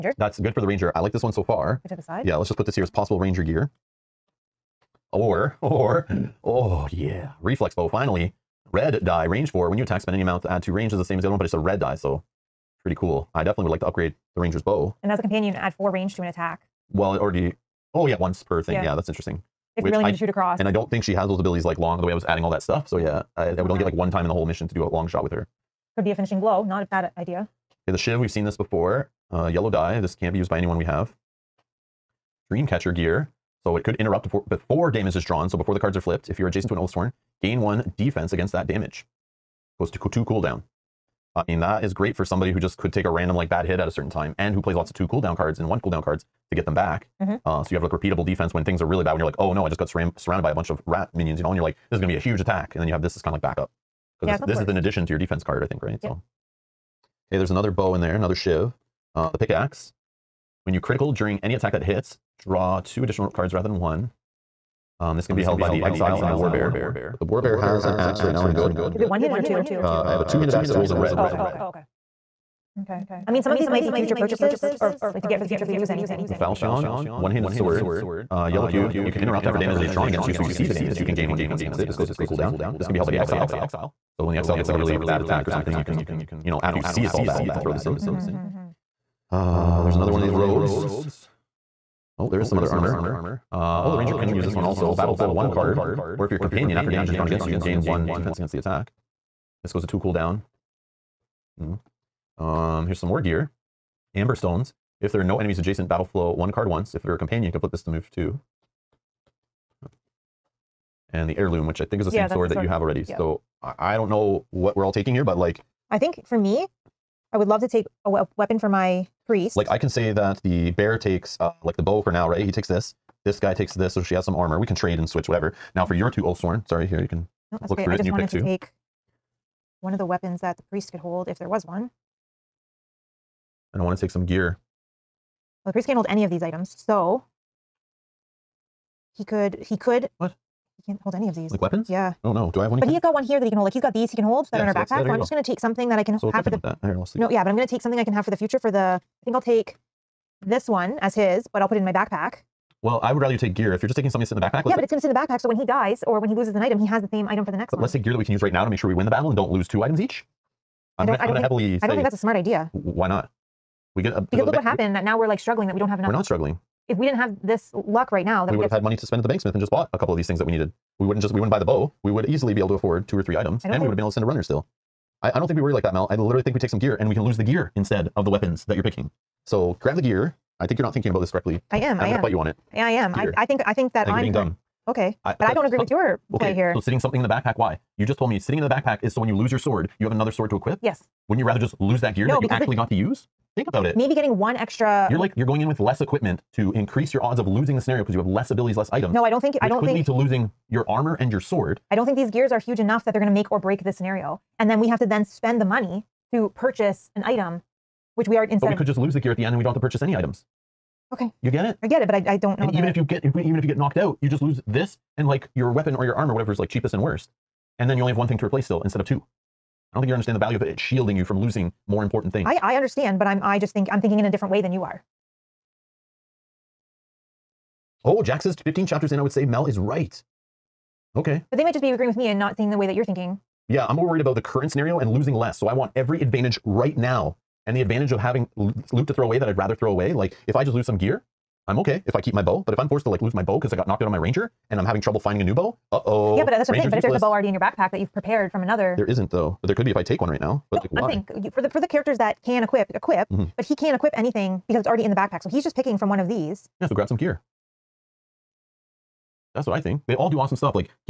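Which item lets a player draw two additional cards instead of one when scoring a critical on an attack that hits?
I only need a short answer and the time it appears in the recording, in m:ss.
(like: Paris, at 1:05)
The pickaxe, at 0:59.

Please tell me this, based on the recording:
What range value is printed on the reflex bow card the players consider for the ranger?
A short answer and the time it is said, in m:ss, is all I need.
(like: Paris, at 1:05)
4, at 0:09.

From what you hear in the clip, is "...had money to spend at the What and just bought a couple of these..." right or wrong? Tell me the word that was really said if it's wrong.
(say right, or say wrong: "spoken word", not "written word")
wrong: "Banksmith", not "What".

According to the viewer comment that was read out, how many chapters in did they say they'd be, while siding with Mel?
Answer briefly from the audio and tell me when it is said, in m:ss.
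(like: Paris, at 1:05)
15, at 3:48.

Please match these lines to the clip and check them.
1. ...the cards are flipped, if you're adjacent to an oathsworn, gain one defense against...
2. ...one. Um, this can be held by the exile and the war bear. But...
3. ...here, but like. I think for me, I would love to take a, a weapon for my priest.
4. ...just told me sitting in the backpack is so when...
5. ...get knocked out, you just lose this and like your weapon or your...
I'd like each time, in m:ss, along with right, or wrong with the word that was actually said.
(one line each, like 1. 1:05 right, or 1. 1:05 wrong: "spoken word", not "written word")
1. 0:35 right
2. 1:03 right
3. 1:55 right
4. 3:08 right
5. 3:33 right.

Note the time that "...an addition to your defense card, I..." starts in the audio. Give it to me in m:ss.
0:54.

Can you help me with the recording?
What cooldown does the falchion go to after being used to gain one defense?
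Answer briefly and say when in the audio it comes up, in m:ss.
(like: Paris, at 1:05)
3, at 1:22.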